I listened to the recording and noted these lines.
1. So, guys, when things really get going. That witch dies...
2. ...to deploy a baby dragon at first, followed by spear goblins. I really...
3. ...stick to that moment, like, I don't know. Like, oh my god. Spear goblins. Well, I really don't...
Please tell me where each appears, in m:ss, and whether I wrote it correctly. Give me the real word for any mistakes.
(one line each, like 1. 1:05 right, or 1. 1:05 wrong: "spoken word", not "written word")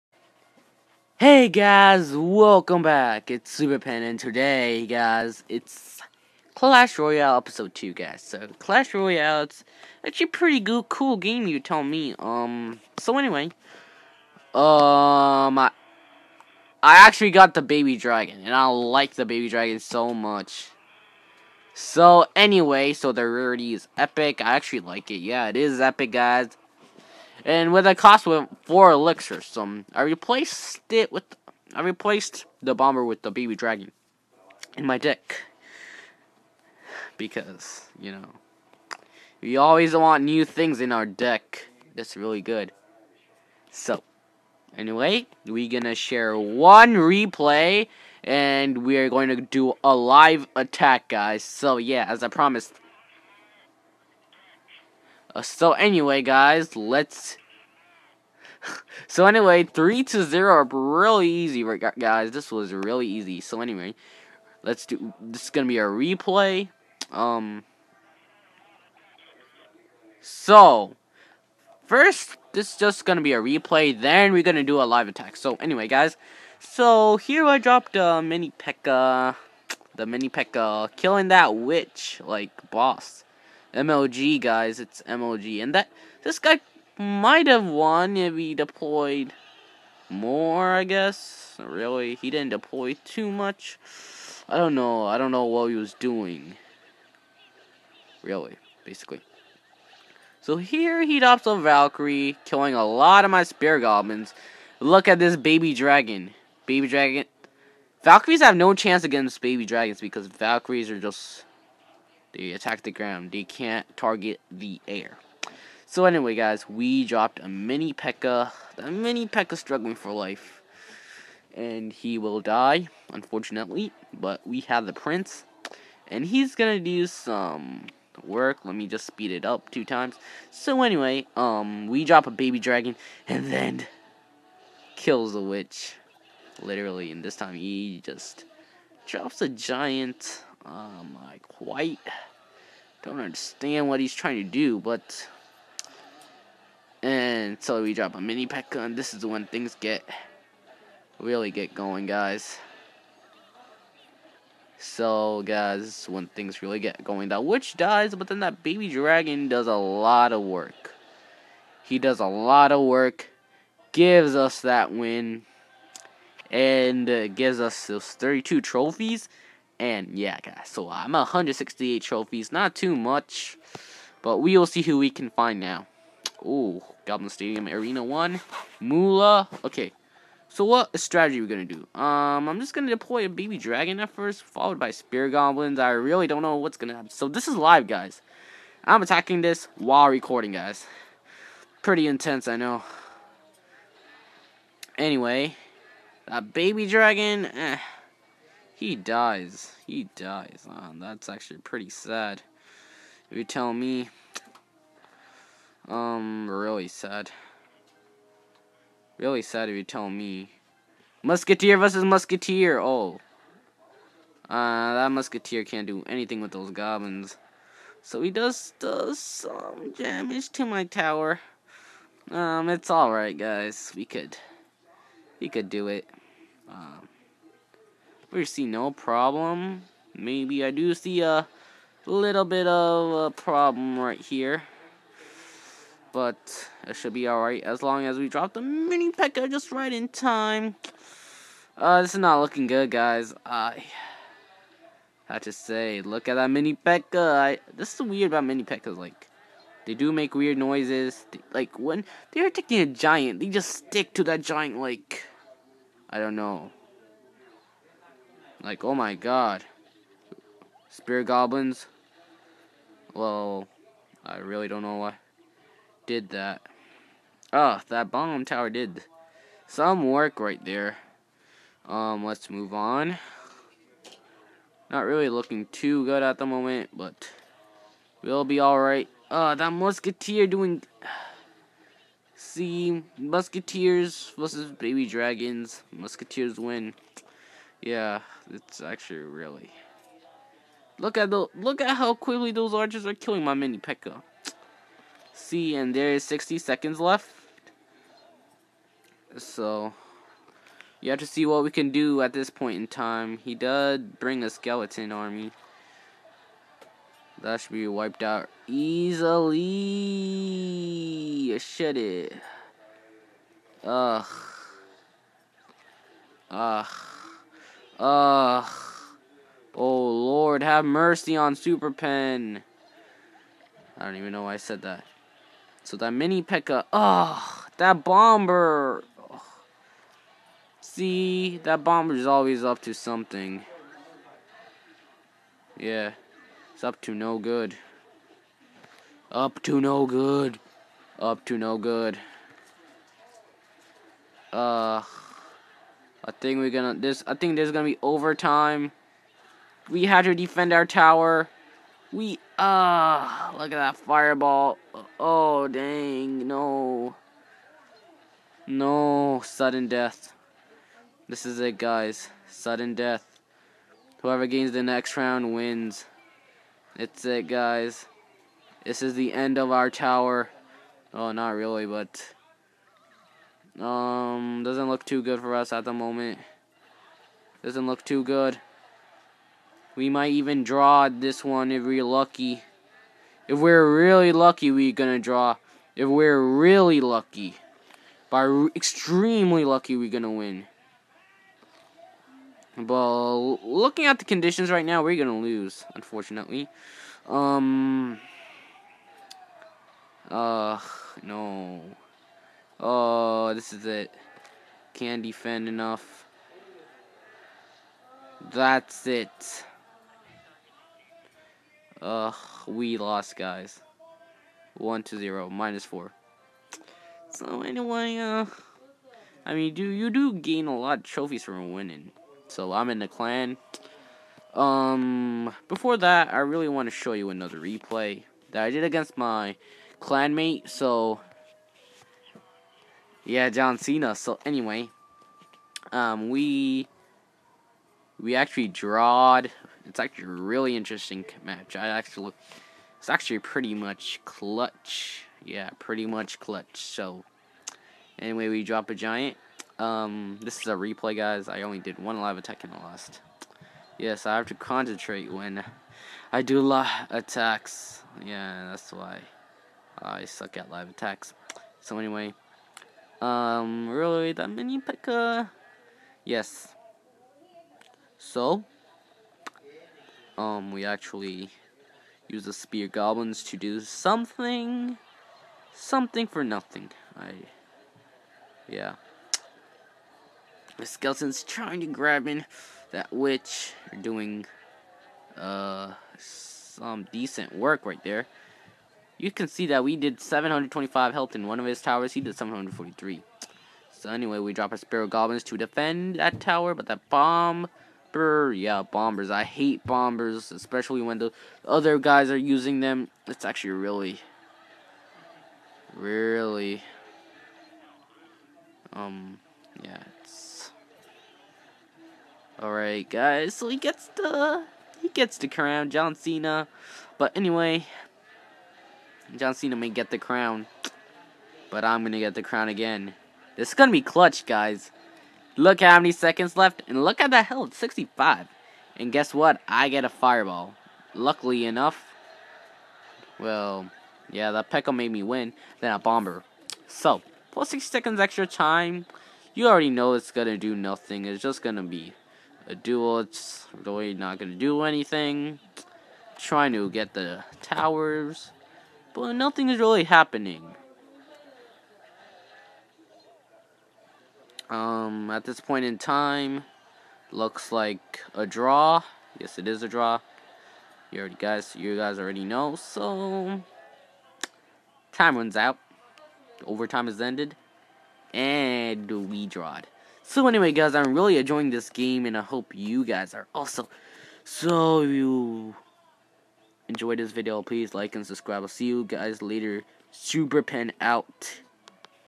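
1. 2:34 right
2. 3:02 right
3. 4:13 wrong: "giant", not "moment".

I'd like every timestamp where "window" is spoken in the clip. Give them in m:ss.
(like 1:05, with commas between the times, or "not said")
not said.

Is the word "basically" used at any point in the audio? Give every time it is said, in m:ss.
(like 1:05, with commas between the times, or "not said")
1:38.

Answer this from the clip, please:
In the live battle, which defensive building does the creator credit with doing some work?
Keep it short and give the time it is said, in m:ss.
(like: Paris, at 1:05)
Bomb tower, at 4:28.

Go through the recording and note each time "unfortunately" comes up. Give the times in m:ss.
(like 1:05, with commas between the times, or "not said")
2:03, 6:35.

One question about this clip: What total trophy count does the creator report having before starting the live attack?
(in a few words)
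168.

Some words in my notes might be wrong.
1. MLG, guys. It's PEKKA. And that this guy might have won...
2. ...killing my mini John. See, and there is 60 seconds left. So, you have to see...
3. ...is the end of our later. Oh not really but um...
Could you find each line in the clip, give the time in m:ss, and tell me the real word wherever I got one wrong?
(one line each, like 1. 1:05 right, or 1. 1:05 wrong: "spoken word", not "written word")
1. 1:23 wrong: "MLG", not "PEKKA"
2. 4:53 wrong: "Pekka", not "John"
3. 6:09 wrong: "tower", not "later".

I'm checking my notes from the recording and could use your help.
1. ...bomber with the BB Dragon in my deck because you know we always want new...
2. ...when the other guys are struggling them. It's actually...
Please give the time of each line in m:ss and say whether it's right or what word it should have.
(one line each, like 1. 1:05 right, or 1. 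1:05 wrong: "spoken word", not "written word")
1. 0:32 right
2. 8:21 wrong: "using", not "struggling".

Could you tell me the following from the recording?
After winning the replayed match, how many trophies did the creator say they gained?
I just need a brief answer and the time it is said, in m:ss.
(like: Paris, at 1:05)
32, at 2:48.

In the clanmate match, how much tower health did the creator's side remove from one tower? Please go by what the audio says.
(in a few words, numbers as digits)
725.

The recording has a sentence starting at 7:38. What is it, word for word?
Yeah, that's why I suck at live attacks.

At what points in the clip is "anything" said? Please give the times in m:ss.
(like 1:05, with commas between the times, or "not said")
3:36, 9:04.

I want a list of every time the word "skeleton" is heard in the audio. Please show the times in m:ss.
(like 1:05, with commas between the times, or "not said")
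5:04, 8:00.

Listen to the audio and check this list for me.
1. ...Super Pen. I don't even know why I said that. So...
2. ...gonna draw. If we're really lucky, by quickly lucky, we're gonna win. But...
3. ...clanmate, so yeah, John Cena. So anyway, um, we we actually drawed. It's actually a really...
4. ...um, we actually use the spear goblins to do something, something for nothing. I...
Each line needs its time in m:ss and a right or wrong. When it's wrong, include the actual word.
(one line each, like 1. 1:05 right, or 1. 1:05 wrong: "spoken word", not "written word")
1. 5:21 right
2. 6:24 wrong: "extremely", not "quickly"
3. 7:10 right
4. 7:50 right.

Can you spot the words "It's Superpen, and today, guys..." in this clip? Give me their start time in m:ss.
0:03.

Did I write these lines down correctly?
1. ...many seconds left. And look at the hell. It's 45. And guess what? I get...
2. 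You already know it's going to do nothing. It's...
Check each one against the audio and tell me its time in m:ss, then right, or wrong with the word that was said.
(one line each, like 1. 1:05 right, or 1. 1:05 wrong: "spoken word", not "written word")
1. 8:45 wrong: "65", not "45"
2. 8:59 right.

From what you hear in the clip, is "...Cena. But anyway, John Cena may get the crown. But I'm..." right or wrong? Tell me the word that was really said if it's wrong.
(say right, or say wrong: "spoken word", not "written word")
right.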